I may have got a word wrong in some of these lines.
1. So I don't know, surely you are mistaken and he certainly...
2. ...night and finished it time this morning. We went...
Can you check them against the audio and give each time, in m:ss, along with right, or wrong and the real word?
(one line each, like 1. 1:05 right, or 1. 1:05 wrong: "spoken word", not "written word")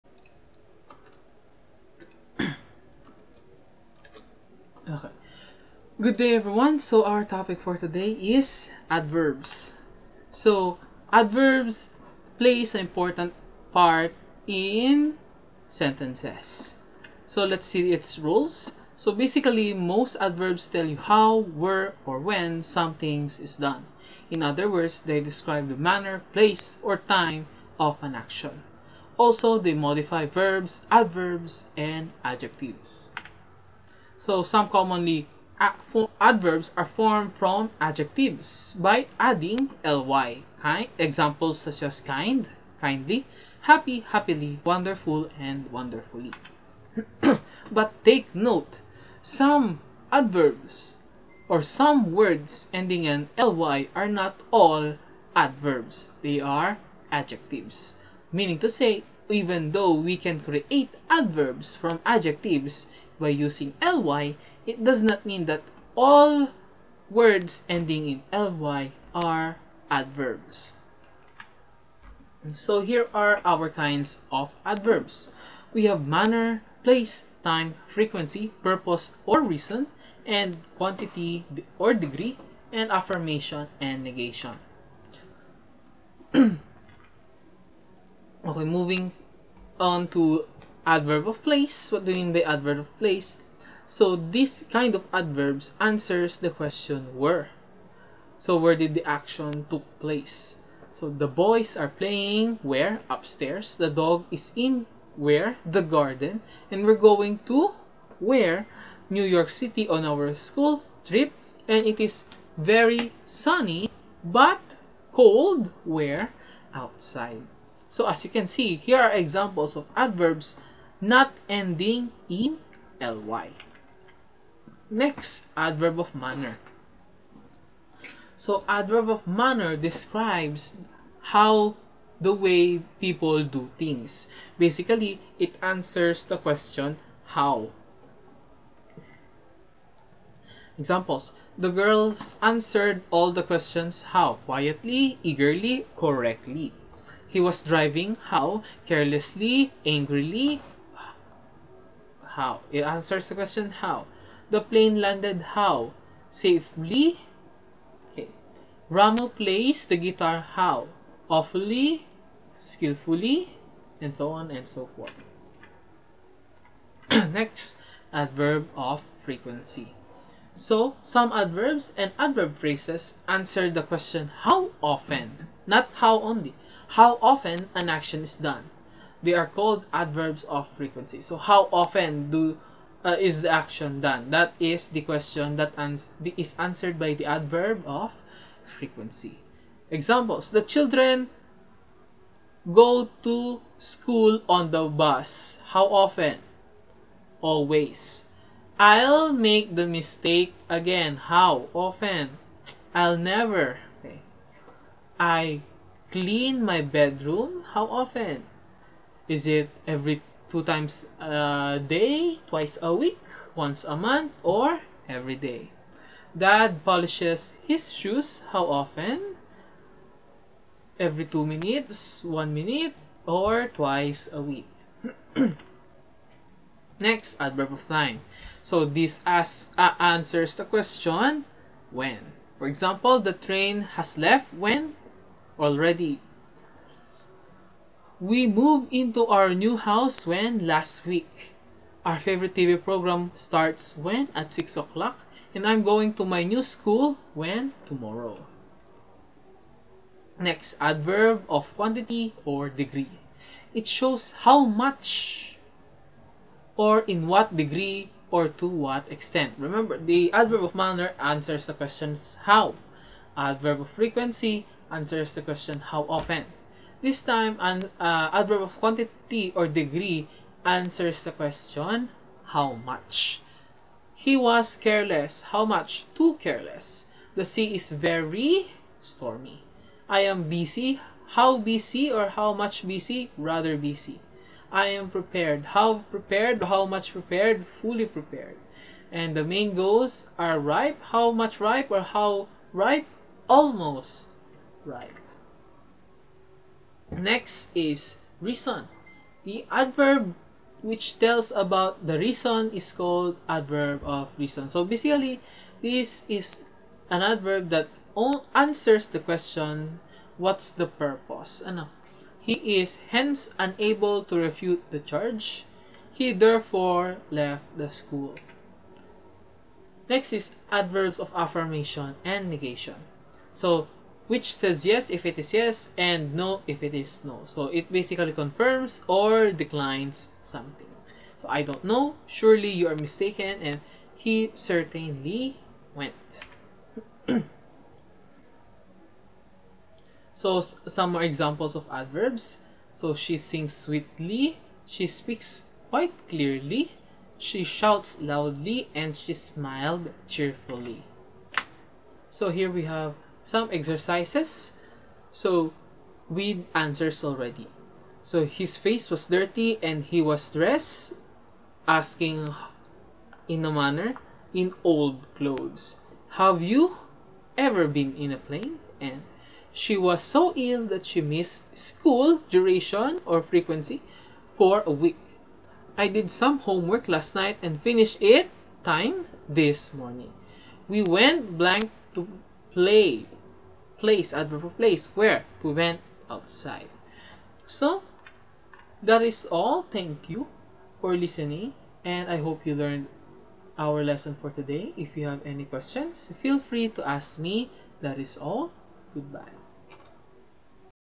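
1. 5:31 right
2. 6:17 right.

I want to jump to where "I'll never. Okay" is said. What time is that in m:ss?
3:22.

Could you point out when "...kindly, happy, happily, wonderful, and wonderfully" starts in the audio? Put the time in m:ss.
0:42.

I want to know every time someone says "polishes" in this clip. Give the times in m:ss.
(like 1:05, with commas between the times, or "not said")
3:36.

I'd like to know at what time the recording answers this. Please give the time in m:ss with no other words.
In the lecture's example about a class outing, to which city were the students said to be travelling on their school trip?
1:49.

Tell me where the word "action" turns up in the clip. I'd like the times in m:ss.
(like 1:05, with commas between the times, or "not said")
0:28, 1:39, 2:57, 3:03.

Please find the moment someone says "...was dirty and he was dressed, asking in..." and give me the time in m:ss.
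5:59.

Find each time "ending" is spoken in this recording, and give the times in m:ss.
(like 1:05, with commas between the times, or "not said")
0:52, 1:07, 2:01.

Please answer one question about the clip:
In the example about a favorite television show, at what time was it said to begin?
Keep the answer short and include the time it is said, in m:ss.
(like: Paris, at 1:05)
6 o'clock, at 4:04.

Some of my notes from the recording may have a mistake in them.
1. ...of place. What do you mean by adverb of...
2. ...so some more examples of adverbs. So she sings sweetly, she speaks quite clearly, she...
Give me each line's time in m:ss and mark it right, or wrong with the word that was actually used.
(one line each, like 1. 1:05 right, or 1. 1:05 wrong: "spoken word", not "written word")
1. 1:31 right
2. 5:40 right.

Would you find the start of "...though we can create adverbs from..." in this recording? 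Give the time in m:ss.
0:59.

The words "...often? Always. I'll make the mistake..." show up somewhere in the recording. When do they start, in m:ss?
3:15.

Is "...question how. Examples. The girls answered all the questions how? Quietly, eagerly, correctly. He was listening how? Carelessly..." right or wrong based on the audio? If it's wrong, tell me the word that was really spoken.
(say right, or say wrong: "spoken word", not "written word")
wrong: "driving", not "listening".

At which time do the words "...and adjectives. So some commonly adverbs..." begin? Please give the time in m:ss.
0:31.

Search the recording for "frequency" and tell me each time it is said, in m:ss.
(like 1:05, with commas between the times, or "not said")
1:17, 2:49, 3:00, 3:08, 4:23, 6:13.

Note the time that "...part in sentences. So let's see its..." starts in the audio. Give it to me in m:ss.
0:13.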